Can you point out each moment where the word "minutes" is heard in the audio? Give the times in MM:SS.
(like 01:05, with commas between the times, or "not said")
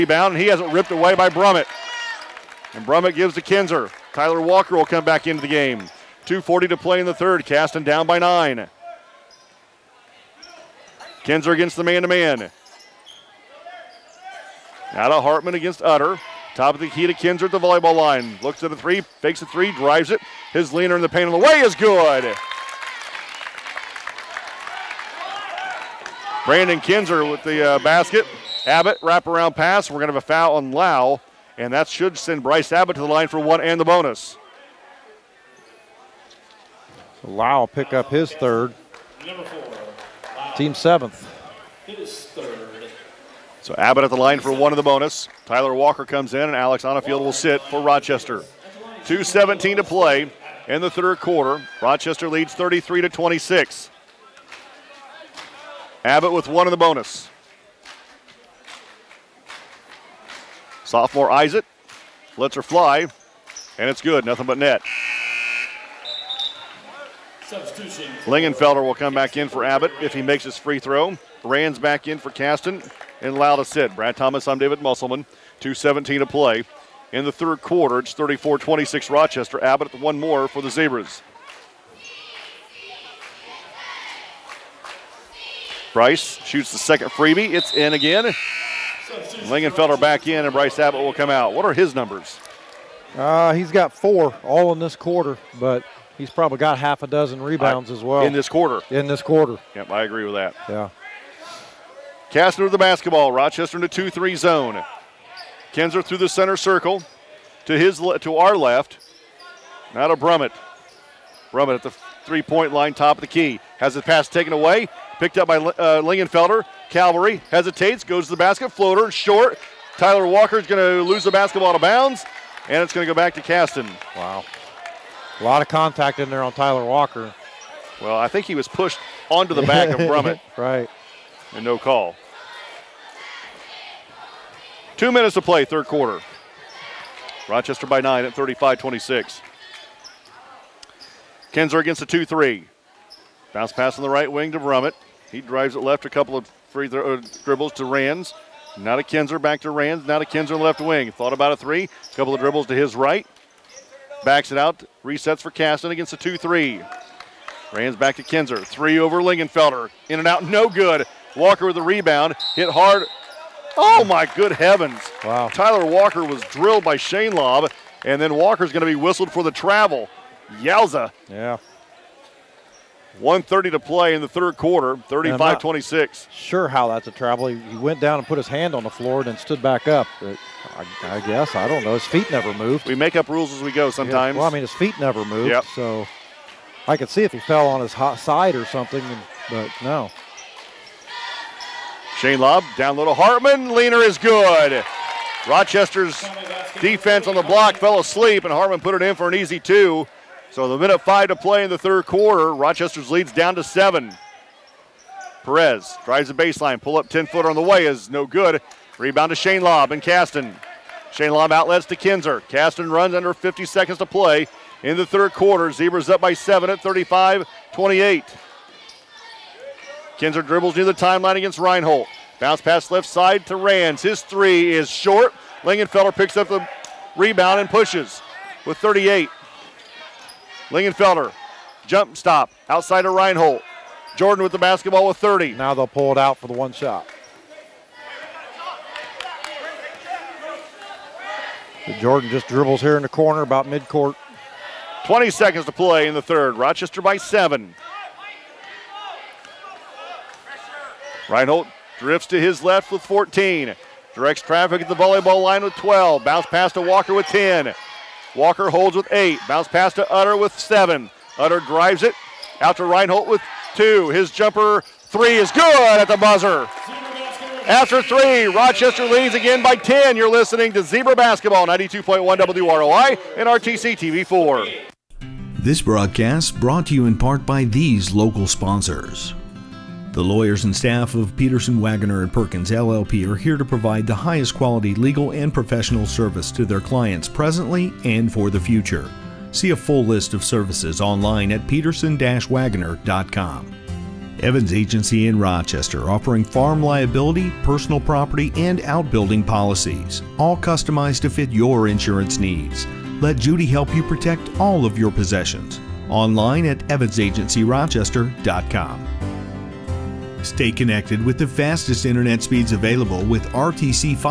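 02:15, 03:20.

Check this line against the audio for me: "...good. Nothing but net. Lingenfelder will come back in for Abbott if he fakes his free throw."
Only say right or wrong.
wrong.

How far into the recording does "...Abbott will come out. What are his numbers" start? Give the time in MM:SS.
01:30.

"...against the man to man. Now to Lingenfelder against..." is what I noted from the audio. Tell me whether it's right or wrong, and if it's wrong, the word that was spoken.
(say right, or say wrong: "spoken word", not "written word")
wrong: "Hartman", not "Lingenfelder".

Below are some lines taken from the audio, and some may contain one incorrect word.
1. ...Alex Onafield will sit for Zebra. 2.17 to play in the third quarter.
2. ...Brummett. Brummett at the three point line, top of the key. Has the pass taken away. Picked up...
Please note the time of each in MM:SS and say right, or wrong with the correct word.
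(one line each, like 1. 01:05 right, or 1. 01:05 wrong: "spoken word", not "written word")
1. 00:46 wrong: "Rochester", not "Zebra"
2. 01:50 right.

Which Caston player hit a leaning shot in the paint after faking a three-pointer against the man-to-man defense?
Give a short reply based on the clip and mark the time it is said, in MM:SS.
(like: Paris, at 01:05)
Brandon Kinzer, at 00:26.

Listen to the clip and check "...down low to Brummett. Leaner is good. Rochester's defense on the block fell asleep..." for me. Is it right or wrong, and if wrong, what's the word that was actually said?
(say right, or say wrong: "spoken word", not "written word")
wrong: "Hartman", not "Brummett".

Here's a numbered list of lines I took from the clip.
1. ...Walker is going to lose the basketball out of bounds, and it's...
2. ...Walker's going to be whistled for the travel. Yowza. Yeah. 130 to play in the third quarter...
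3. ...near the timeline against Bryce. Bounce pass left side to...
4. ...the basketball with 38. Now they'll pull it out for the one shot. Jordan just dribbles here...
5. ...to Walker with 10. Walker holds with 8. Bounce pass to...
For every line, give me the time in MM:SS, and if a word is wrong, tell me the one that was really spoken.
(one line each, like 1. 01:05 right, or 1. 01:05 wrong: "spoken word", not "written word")
1. 02:00 right
2. 02:48 right
3. 03:40 wrong: "Reinhold", not "Bryce"
4. 03:54 wrong: "30", not "38"
5. 04:16 right.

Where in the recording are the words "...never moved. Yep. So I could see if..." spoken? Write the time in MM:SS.
03:04.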